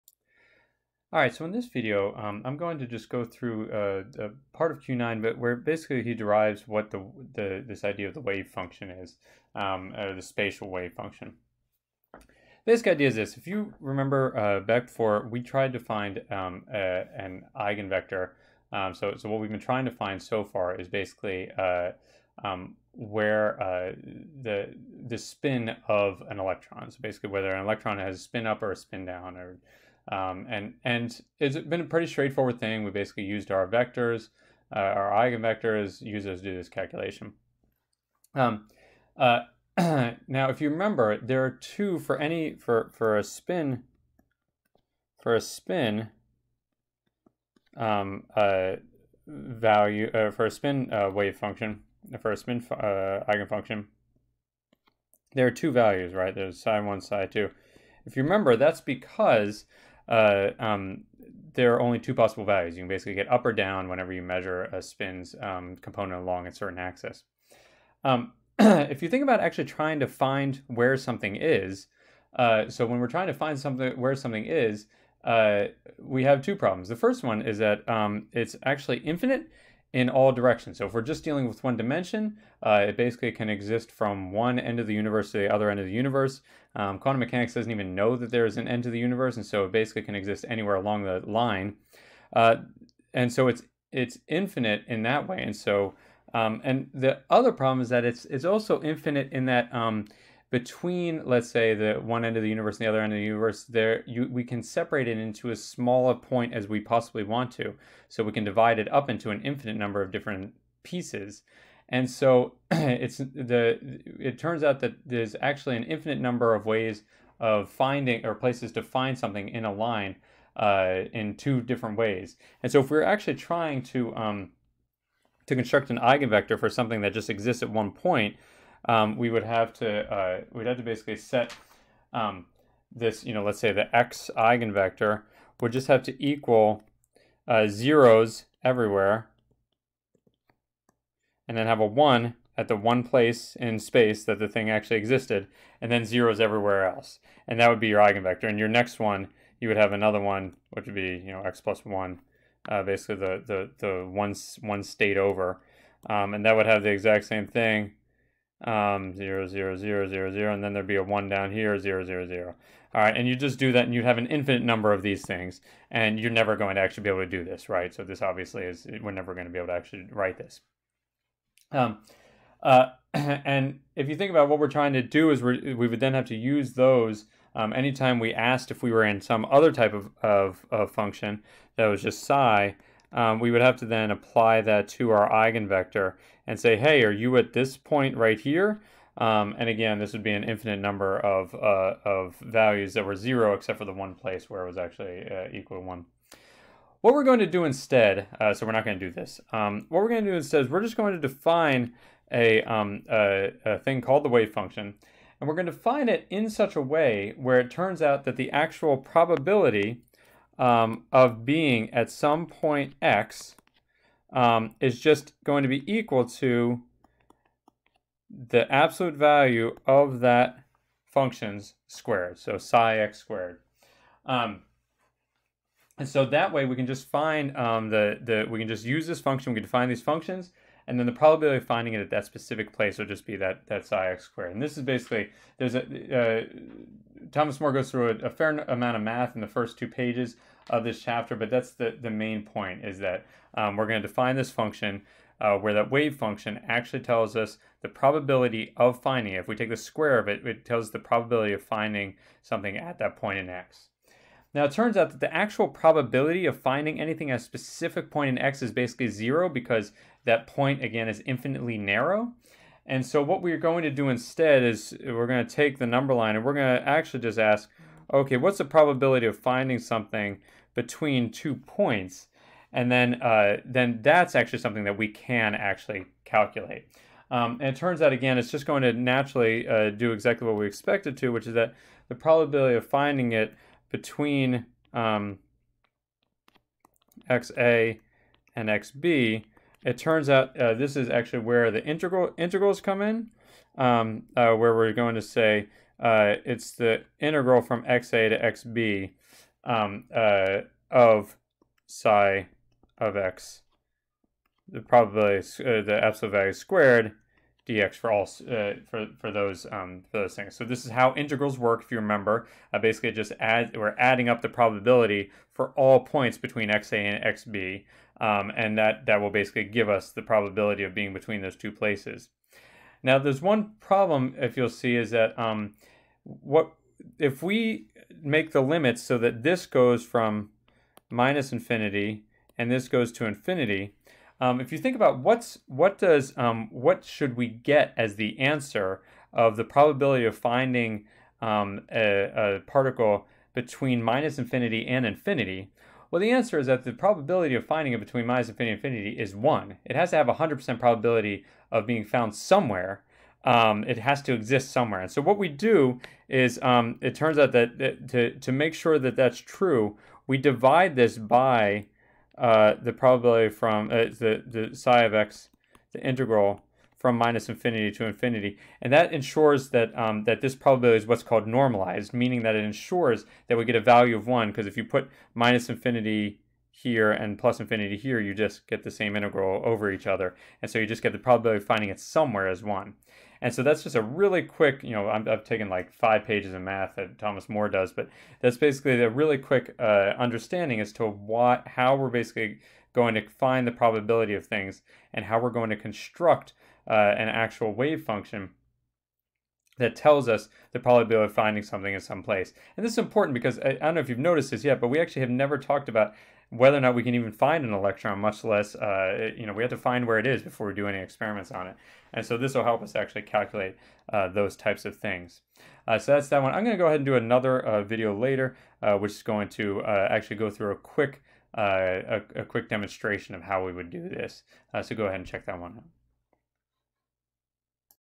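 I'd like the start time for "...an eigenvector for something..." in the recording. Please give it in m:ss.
2:05.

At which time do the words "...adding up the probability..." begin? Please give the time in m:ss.
5:13.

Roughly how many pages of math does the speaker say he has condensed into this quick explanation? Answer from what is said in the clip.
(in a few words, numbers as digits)
5.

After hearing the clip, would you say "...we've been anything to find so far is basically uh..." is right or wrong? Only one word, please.
wrong.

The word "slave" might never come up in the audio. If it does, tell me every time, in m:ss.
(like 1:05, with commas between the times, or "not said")
not said.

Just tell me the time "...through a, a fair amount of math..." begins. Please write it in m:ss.
3:57.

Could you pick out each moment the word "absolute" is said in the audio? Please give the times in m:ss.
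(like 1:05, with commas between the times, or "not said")
3:38, 5:06.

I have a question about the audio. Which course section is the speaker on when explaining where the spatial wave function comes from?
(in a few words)
Q9.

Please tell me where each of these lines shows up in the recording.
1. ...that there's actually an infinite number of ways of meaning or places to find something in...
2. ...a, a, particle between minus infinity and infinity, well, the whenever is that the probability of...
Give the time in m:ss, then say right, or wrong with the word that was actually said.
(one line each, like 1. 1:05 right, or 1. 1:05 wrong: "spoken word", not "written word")
1. 1:54 wrong: "finding", not "meaning"
2. 5:41 wrong: "answer", not "whenever".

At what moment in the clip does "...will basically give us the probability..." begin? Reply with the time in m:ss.
5:19.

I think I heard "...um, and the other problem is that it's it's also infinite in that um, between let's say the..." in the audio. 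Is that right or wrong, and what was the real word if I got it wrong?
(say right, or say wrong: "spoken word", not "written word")
right.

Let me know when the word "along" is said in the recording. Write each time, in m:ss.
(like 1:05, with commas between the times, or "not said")
1:06, 1:30.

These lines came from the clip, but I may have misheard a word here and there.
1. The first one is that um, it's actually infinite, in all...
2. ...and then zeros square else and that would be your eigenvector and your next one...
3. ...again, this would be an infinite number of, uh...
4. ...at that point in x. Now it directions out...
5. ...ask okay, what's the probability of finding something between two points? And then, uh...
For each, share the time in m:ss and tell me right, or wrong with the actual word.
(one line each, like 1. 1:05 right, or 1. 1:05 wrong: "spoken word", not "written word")
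1. 1:16 right
2. 2:25 wrong: "everywhere", not "square"
3. 3:09 right
4. 4:12 wrong: "turns", not "directions"
5. 4:27 right.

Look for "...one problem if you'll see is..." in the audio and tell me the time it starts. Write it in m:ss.
5:23.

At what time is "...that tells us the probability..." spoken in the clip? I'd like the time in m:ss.
6:39.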